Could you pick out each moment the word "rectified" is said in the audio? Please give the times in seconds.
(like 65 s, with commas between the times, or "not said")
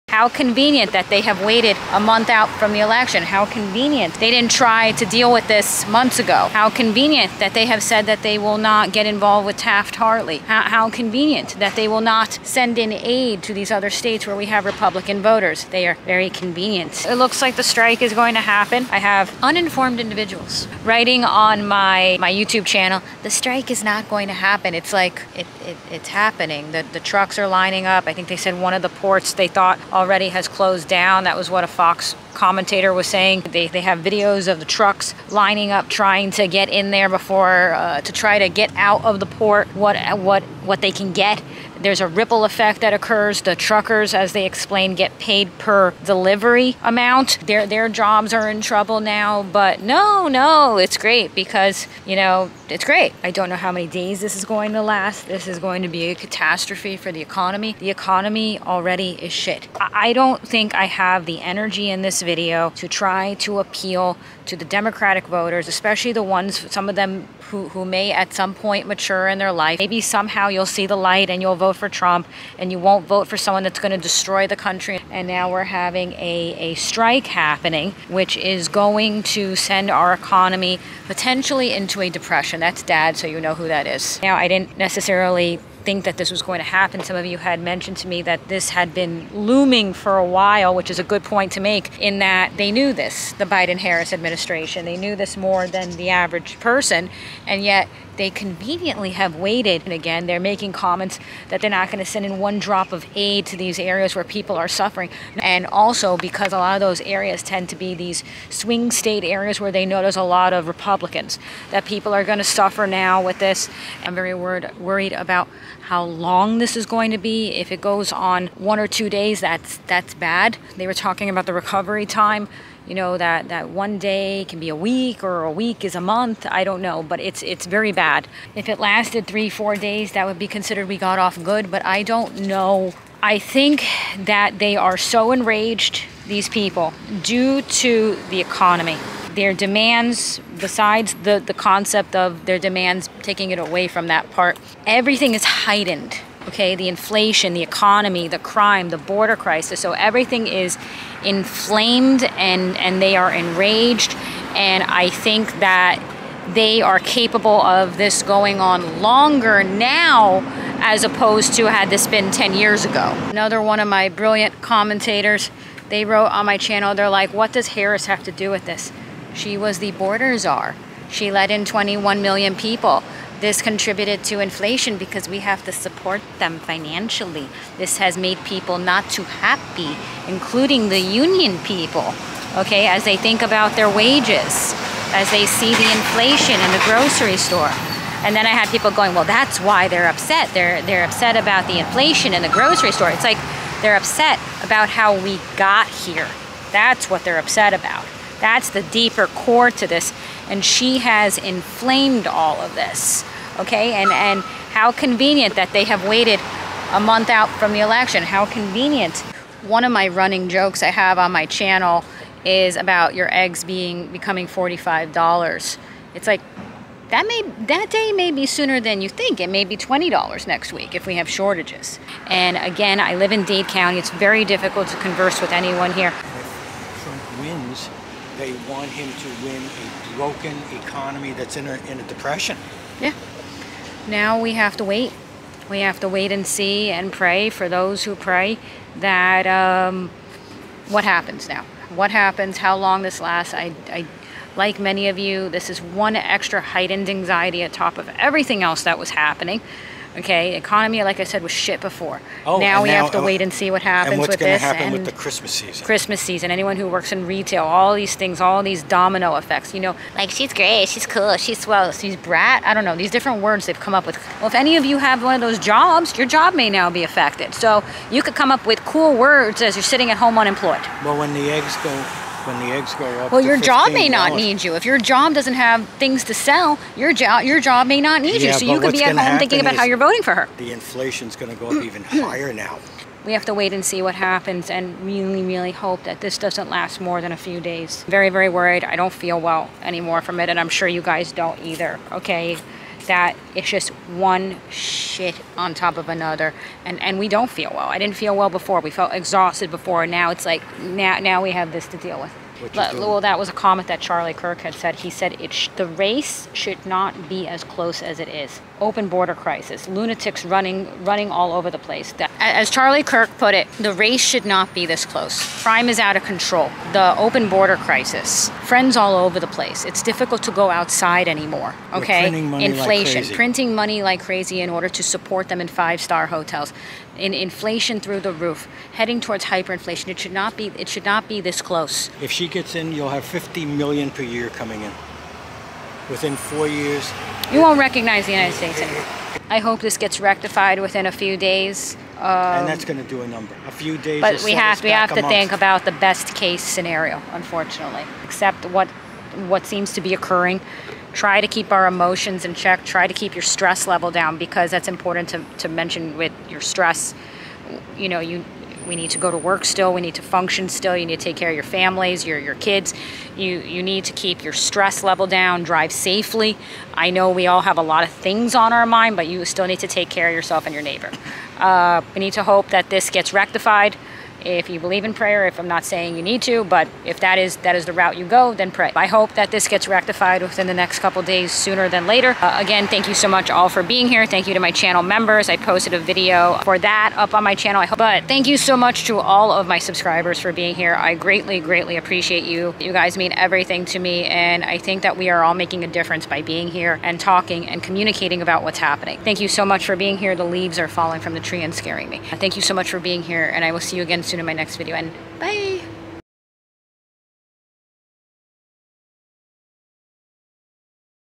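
340 s, 373 s, 379 s.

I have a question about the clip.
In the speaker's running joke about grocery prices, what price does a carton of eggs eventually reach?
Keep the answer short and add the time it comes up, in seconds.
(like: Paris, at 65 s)
$45, at 214 s.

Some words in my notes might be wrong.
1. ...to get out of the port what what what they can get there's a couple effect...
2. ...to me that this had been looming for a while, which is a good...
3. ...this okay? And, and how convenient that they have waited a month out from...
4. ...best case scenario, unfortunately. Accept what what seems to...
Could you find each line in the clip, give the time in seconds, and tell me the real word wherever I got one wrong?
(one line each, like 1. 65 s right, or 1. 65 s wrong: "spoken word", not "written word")
1. 38 s wrong: "ripple", not "couple"
2. 87 s right
3. 202 s right
4. 345 s right.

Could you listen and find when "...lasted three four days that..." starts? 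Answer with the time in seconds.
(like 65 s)
128 s.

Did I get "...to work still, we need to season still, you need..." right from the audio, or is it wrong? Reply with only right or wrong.
wrong.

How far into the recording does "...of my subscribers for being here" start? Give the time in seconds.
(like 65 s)
389 s.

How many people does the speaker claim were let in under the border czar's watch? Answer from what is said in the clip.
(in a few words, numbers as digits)
21 million.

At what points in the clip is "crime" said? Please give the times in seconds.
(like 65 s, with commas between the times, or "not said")
148 s, 315 s.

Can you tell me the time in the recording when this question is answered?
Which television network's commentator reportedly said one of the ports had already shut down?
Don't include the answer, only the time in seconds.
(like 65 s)
31 s.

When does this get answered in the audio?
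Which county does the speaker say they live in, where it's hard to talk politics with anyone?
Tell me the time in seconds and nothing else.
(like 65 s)
223 s.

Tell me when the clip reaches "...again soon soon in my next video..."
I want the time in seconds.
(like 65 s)
404 s.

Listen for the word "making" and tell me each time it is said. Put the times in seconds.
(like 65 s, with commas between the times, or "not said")
100 s, 395 s.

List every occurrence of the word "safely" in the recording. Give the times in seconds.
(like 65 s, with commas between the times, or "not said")
365 s.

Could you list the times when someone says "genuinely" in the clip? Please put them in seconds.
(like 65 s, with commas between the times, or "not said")
not said.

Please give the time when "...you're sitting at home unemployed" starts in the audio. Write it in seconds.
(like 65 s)
269 s.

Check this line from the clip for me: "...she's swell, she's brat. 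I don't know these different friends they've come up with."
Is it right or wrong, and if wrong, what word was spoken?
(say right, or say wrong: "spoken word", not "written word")
wrong: "words", not "friends".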